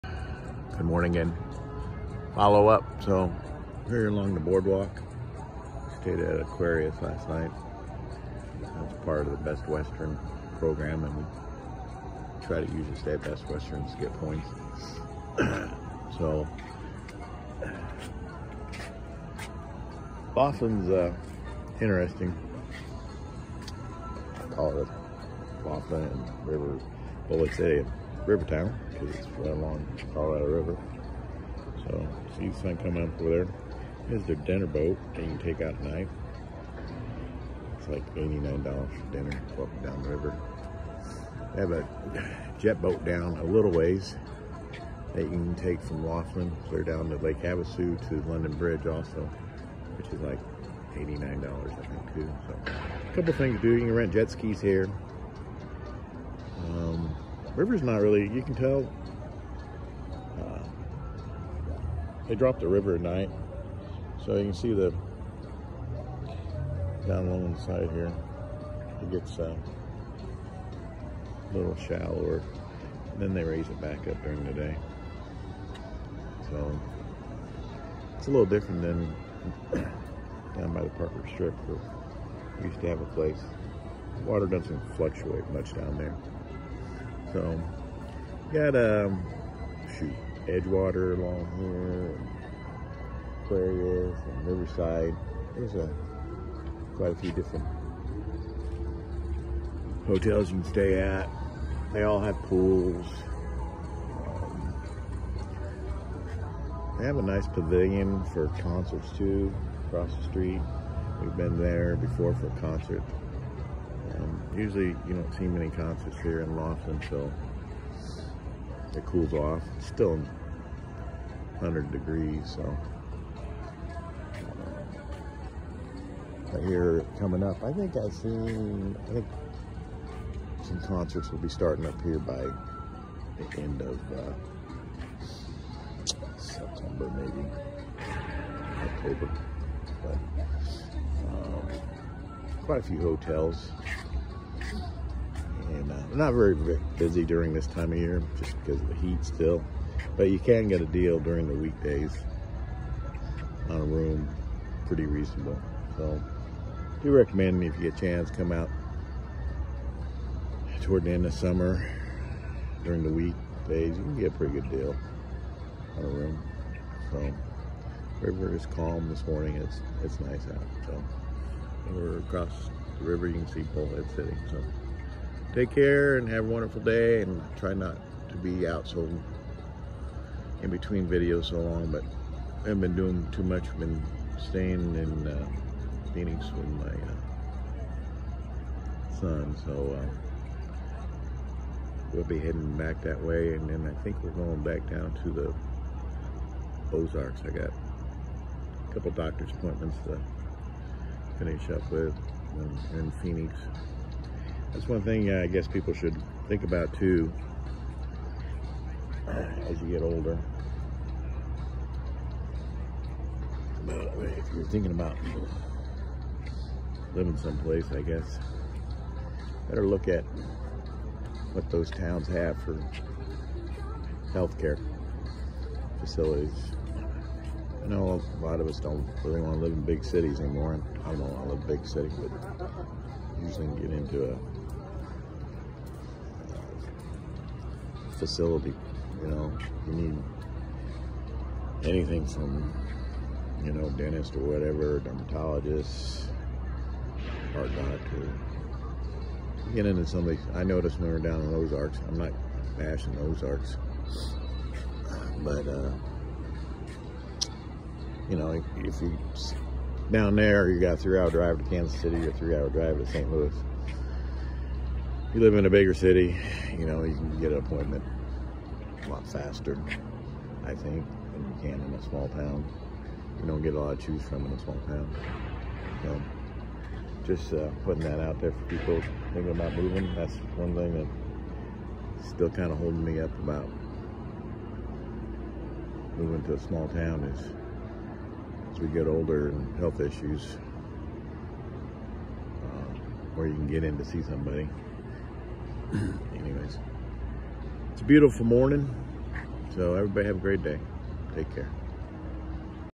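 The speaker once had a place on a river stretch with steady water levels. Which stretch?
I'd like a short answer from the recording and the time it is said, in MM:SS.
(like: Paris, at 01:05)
Parker Strip, at 01:20.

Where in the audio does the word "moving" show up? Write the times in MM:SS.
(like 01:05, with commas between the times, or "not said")
04:39, 04:46.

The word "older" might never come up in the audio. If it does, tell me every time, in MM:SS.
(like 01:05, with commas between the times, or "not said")
03:30, 04:49.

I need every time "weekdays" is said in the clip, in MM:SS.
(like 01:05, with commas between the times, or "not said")
02:31, 02:43.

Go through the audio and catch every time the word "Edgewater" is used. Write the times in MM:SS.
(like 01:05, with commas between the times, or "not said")
01:30.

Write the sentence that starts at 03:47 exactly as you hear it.
I know a lot of us don't really want to live in big cities anymore.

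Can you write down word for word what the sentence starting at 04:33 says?
You don't get a lot to choose from in a small town.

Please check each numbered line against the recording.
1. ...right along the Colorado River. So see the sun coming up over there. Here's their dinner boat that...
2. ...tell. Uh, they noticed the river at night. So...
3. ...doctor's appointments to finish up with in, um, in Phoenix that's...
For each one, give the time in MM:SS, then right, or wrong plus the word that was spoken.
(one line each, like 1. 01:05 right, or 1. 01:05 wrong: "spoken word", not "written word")
1. 00:29 right
2. 00:58 wrong: "dropped", not "noticed"
3. 03:19 right.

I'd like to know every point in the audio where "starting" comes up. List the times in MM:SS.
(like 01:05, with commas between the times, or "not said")
02:11.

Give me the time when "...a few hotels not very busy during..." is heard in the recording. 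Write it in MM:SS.
02:22.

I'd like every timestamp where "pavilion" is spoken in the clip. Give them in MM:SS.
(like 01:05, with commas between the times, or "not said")
01:47.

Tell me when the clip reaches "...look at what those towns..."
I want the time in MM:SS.
03:39.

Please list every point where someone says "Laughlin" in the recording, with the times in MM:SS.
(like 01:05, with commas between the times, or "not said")
00:46, 01:56.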